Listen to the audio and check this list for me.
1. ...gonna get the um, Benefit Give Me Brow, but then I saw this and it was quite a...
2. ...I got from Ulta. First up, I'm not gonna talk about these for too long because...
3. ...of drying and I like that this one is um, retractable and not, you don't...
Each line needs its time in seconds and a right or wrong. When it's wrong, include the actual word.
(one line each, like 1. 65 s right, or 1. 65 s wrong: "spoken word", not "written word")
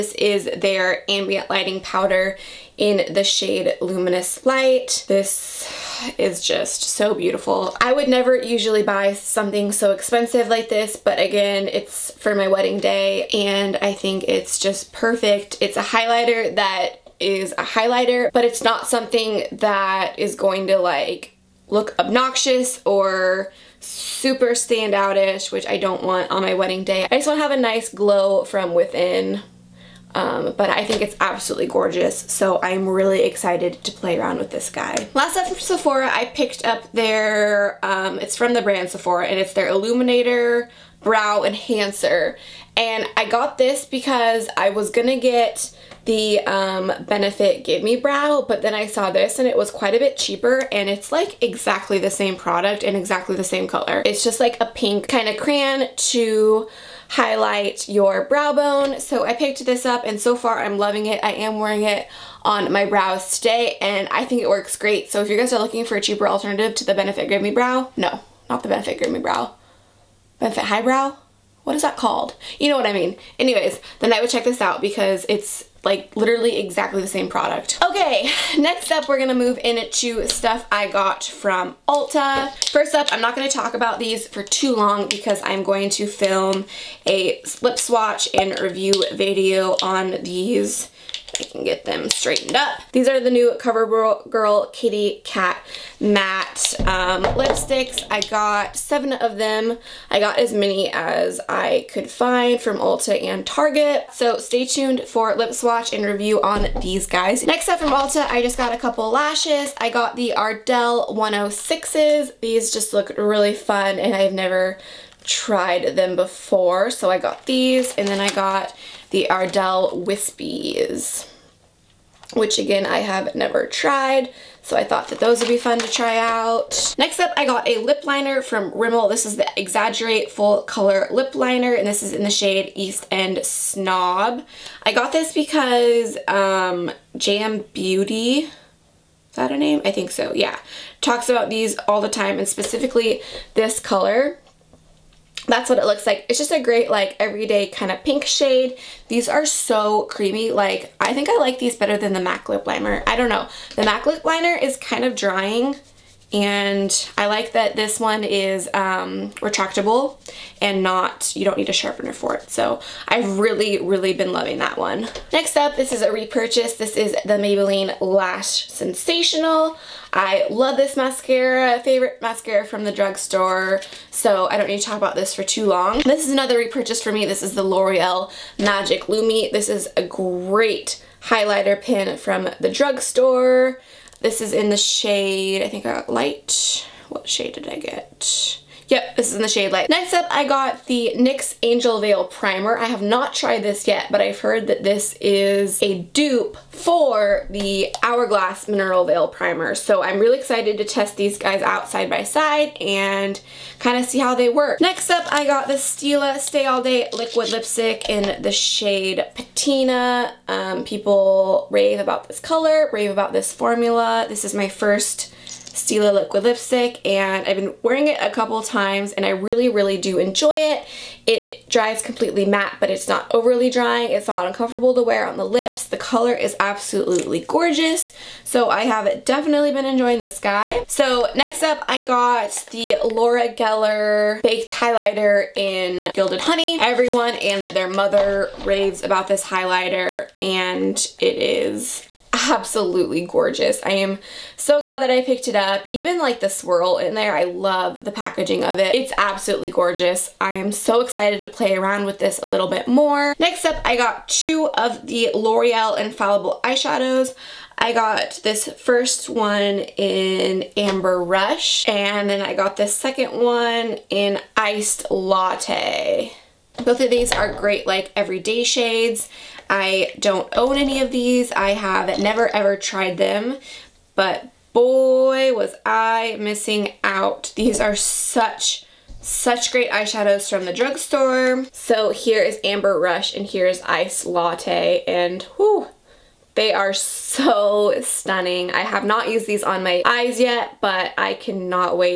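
1. 44 s right
2. 80 s right
3. 155 s right.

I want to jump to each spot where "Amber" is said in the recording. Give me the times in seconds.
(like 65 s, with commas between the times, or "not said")
260 s, 282 s.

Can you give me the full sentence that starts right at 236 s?
Everyone and their mother raves about this highlighter and it is absolutely gorgeous.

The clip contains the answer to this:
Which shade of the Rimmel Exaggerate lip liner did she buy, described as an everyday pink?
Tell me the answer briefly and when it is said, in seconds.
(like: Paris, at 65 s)
East End Snob, at 132 s.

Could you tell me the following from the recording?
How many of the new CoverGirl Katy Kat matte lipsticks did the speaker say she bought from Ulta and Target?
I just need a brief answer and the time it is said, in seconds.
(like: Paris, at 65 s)
7, at 98 s.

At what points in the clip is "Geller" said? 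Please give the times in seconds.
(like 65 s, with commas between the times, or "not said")
233 s.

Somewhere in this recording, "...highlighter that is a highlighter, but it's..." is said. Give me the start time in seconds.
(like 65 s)
15 s.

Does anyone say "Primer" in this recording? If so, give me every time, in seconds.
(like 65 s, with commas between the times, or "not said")
192 s, 199 s.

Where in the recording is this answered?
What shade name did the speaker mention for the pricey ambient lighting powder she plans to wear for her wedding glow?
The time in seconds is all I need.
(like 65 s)
3 s.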